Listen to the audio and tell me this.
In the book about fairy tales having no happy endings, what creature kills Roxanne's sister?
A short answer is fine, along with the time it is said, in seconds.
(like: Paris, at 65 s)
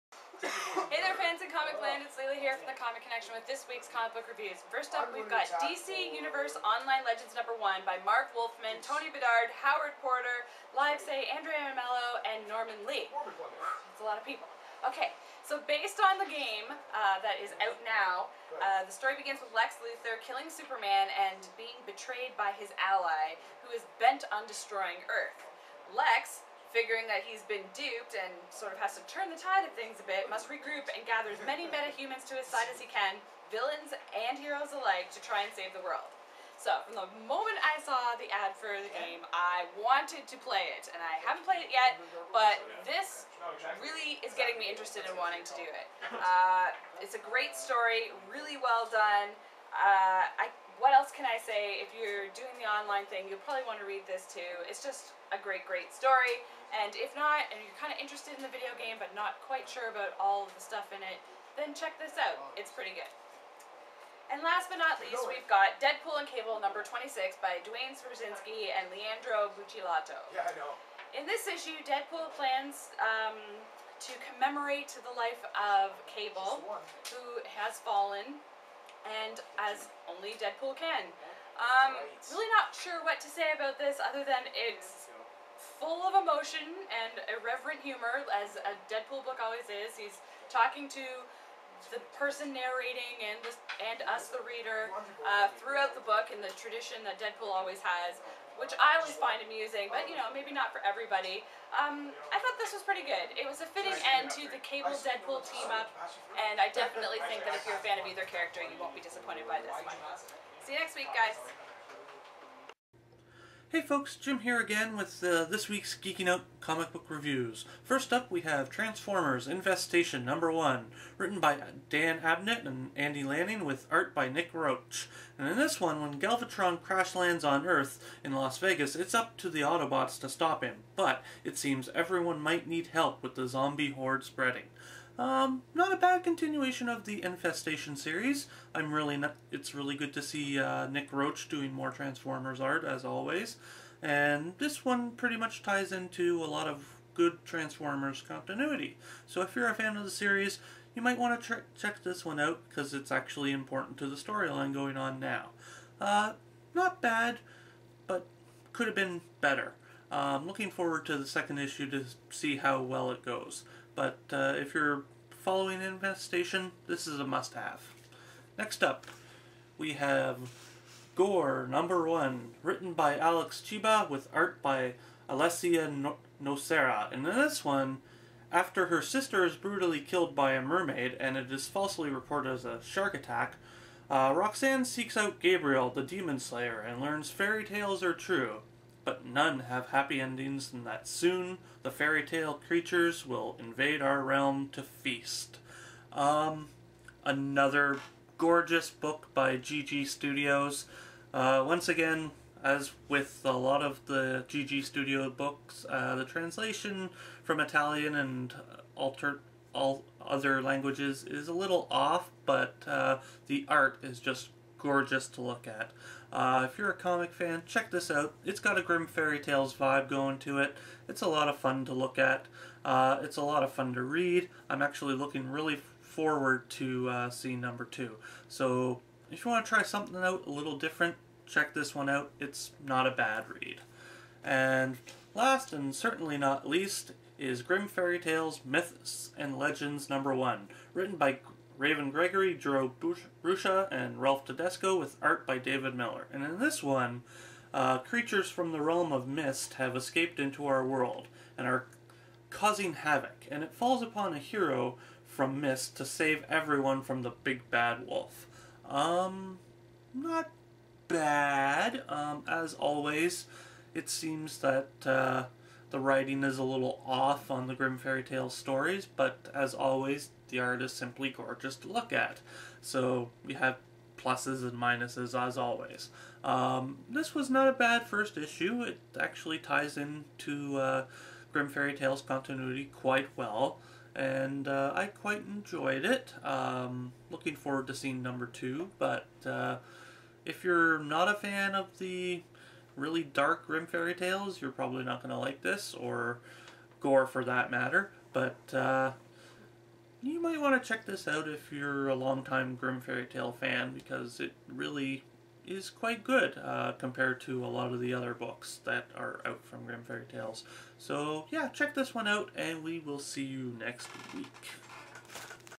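mermaid, at 180 s.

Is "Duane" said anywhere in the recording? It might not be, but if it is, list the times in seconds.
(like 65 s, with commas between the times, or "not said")
67 s.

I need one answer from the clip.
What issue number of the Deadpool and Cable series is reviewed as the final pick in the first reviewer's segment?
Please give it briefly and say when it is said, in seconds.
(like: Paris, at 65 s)
26, at 66 s.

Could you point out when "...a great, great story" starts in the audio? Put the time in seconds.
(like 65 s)
55 s.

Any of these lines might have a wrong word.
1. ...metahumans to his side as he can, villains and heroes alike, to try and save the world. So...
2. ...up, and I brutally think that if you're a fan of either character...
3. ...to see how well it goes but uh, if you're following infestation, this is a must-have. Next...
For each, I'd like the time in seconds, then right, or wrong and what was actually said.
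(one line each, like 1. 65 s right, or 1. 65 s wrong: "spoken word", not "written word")
1. 31 s right
2. 105 s wrong: "definitely", not "brutally"
3. 161 s right.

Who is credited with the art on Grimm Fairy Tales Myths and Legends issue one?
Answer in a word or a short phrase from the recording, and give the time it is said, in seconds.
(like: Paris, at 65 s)
David Miller, at 245 s.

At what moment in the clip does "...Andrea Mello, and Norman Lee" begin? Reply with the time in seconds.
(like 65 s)
11 s.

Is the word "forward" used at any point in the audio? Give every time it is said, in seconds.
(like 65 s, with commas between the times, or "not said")
160 s, 226 s, 287 s.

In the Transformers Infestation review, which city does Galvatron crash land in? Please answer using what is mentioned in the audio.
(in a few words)
Las Vegas.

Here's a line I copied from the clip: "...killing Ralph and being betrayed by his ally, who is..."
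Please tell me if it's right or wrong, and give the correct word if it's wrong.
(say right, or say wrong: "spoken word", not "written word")
wrong: "Superman", not "Ralph".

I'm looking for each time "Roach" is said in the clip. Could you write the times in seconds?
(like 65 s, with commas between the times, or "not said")
124 s, 141 s.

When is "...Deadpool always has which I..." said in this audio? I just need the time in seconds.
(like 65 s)
97 s.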